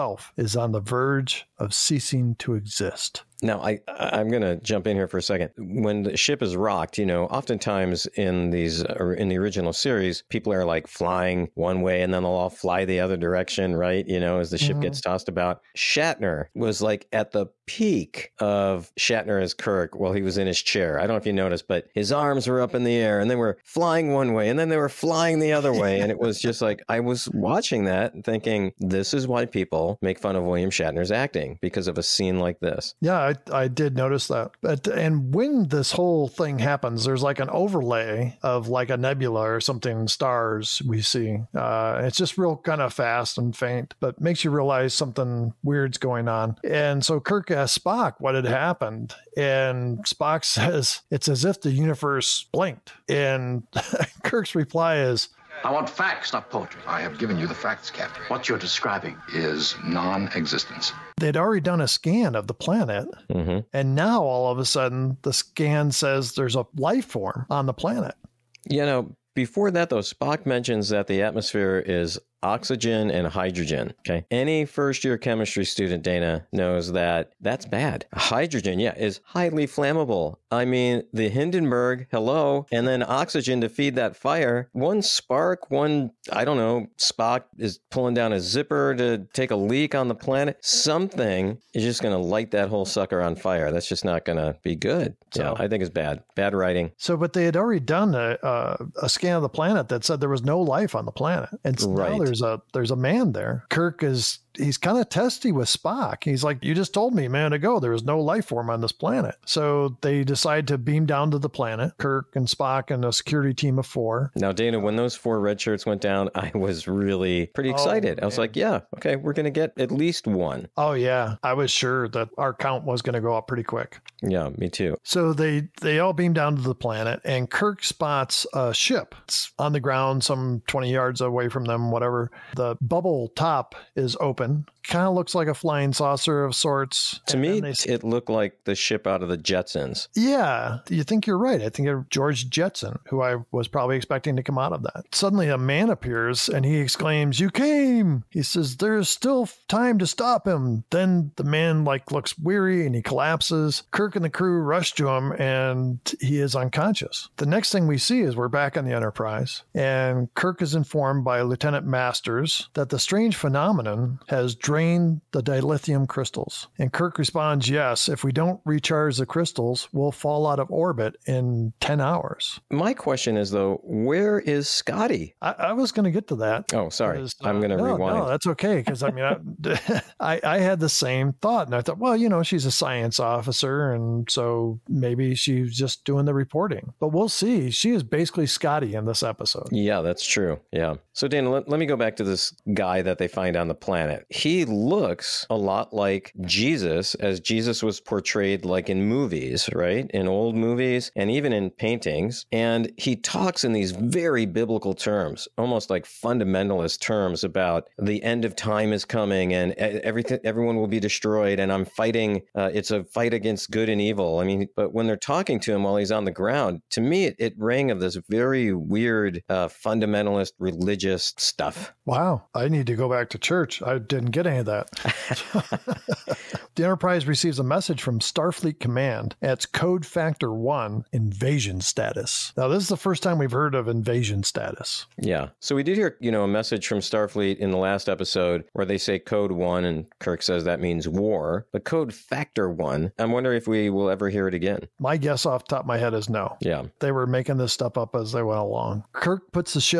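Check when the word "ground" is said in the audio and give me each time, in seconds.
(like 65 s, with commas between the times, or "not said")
129 s, 216 s.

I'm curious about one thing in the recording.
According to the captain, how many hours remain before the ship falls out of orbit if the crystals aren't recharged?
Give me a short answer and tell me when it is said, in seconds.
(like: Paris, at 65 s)
10, at 171 s.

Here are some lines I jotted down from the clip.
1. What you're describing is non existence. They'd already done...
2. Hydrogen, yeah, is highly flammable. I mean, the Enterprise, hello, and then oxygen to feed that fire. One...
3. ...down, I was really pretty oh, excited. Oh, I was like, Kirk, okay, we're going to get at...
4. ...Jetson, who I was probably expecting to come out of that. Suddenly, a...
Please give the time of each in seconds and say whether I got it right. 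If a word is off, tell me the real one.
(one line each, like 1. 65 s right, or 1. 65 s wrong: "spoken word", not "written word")
1. 58 s right
2. 78 s wrong: "Hindenburg", not "Enterprise"
3. 116 s wrong: "Yeah", not "Kirk"
4. 142 s right.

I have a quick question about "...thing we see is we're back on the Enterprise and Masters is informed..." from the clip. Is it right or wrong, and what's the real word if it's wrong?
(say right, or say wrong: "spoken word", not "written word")
wrong: "Kirk", not "Masters".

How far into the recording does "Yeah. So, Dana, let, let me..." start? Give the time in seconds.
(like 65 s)
190 s.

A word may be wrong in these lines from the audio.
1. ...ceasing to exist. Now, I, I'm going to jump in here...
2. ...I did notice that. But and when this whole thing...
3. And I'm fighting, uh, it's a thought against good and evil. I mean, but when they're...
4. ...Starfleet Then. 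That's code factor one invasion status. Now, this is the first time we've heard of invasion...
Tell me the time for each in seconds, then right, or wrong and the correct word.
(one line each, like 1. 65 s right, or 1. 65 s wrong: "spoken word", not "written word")
1. 1 s right
2. 33 s right
3. 211 s wrong: "fight", not "thought"
4. 228 s wrong: "Command", not "Then".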